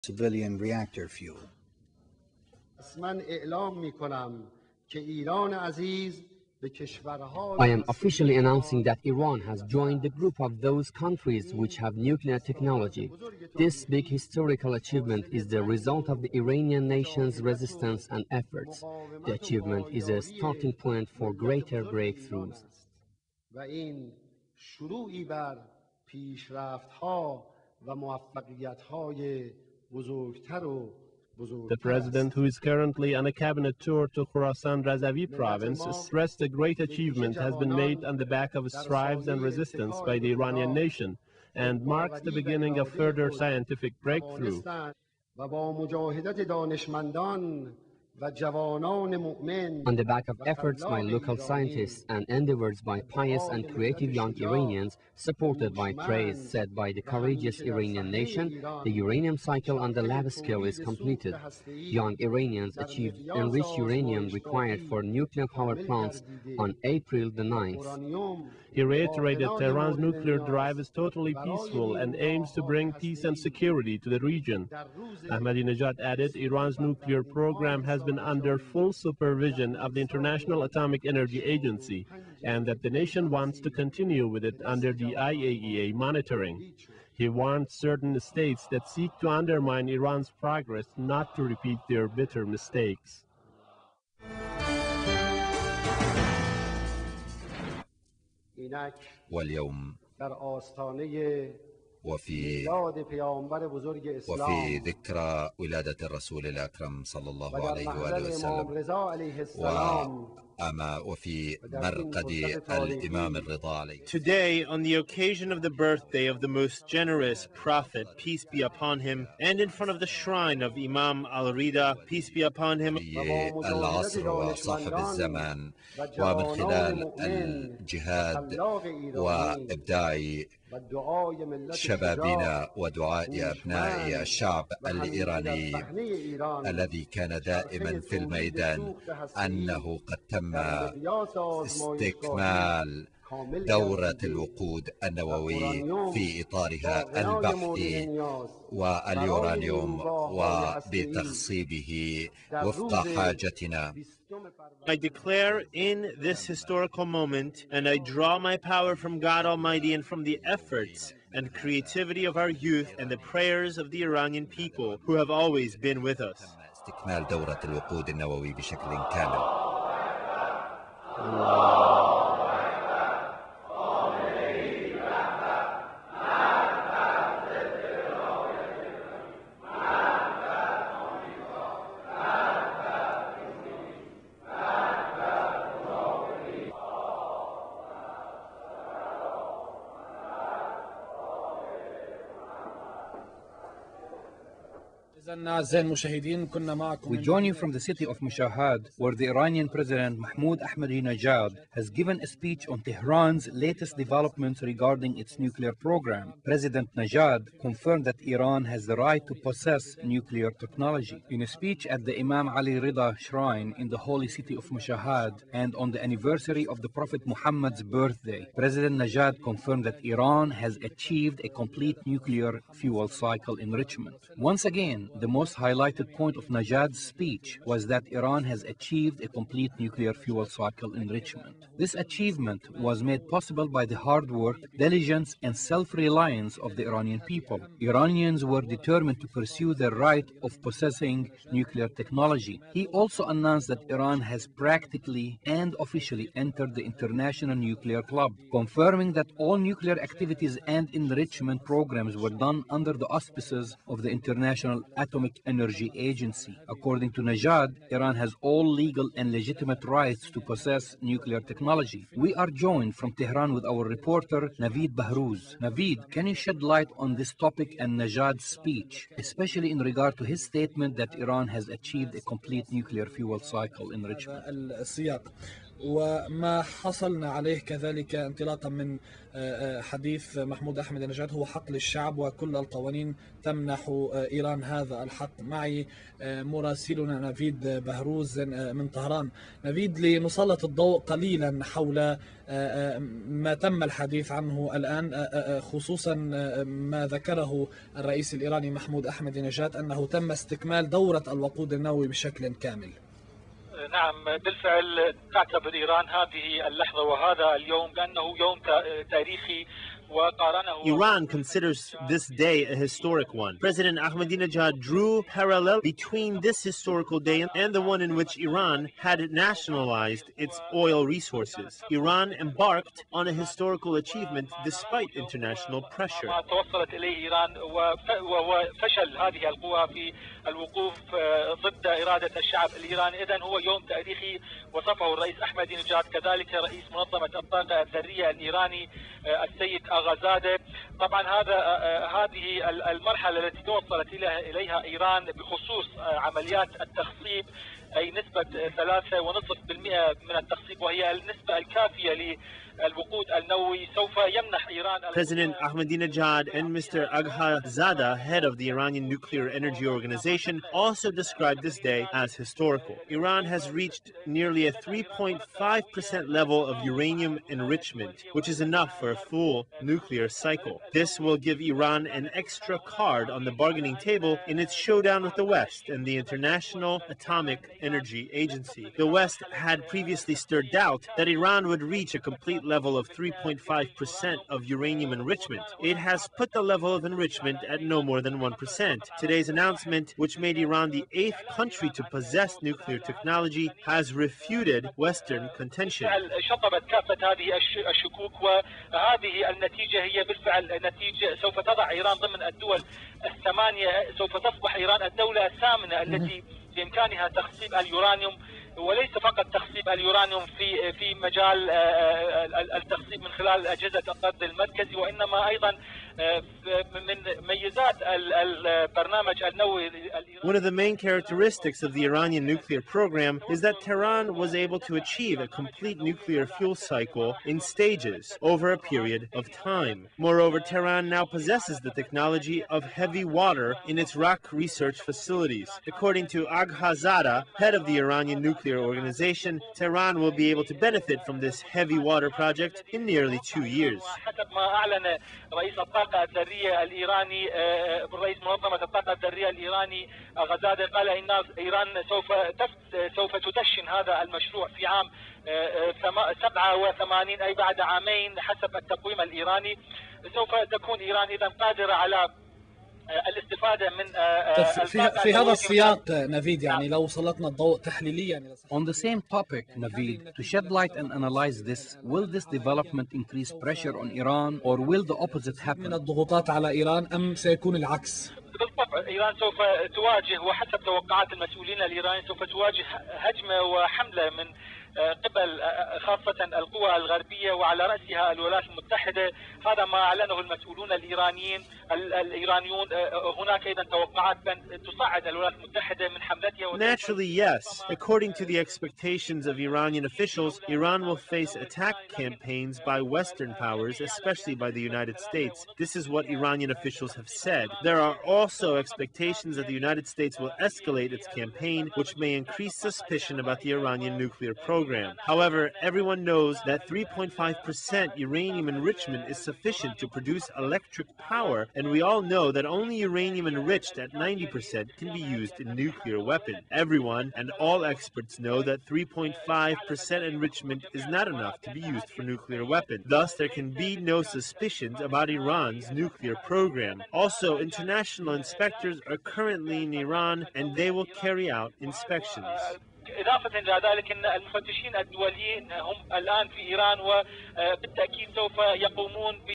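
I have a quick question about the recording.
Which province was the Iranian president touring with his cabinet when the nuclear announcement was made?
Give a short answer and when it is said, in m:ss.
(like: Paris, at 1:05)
Khorasan Razavi, at 0:34.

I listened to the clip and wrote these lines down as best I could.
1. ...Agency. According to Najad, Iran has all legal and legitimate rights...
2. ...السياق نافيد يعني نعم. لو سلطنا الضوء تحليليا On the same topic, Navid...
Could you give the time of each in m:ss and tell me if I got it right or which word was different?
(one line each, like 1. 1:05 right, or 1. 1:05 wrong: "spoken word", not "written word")
1. 4:15 right
2. 7:45 right.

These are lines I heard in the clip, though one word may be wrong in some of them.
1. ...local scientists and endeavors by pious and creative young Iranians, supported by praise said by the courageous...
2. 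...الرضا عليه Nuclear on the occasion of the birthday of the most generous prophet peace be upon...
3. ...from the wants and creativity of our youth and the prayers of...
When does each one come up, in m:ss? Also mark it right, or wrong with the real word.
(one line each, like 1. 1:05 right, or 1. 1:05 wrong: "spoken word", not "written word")
1. 0:51 right
2. 1:53 wrong: "Today", not "Nuclear"
3. 2:40 wrong: "efforts", not "wants".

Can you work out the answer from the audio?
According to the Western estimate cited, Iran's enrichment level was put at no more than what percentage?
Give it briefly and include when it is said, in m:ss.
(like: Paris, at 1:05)
1%, at 6:28.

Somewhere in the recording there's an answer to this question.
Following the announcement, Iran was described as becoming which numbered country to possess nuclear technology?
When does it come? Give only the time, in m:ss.
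6:31.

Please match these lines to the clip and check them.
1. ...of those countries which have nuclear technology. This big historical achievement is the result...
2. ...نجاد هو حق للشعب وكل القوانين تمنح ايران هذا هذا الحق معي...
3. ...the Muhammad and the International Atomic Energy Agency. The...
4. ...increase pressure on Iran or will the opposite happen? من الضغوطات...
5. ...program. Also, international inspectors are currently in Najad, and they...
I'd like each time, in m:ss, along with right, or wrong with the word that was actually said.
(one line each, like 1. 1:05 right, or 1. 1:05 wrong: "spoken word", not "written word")
1. 0:10 right
2. 4:41 right
3. 6:15 wrong: "West", not "Muhammad"
4. 7:53 right
5. 8:56 wrong: "Iran", not "Najad".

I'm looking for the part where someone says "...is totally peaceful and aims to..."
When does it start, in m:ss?
1:10.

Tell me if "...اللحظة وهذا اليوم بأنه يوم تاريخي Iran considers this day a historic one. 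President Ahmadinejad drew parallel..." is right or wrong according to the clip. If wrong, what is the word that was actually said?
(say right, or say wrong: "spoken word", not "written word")
right.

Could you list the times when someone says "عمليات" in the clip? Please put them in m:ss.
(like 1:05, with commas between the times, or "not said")
5:46.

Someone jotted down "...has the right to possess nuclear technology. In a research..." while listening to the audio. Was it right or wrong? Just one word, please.
wrong.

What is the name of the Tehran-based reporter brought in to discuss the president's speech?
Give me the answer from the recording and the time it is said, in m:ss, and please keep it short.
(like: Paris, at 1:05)
Navid Bahrouz, at 4:24.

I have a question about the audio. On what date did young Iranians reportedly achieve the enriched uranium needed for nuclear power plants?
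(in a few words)
April 9th.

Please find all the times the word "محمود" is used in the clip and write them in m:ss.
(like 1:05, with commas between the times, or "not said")
4:40, 4:58.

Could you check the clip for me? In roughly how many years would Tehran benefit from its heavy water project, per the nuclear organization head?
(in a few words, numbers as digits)
2 years.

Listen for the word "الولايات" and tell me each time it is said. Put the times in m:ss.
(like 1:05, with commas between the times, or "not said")
8:08, 8:15.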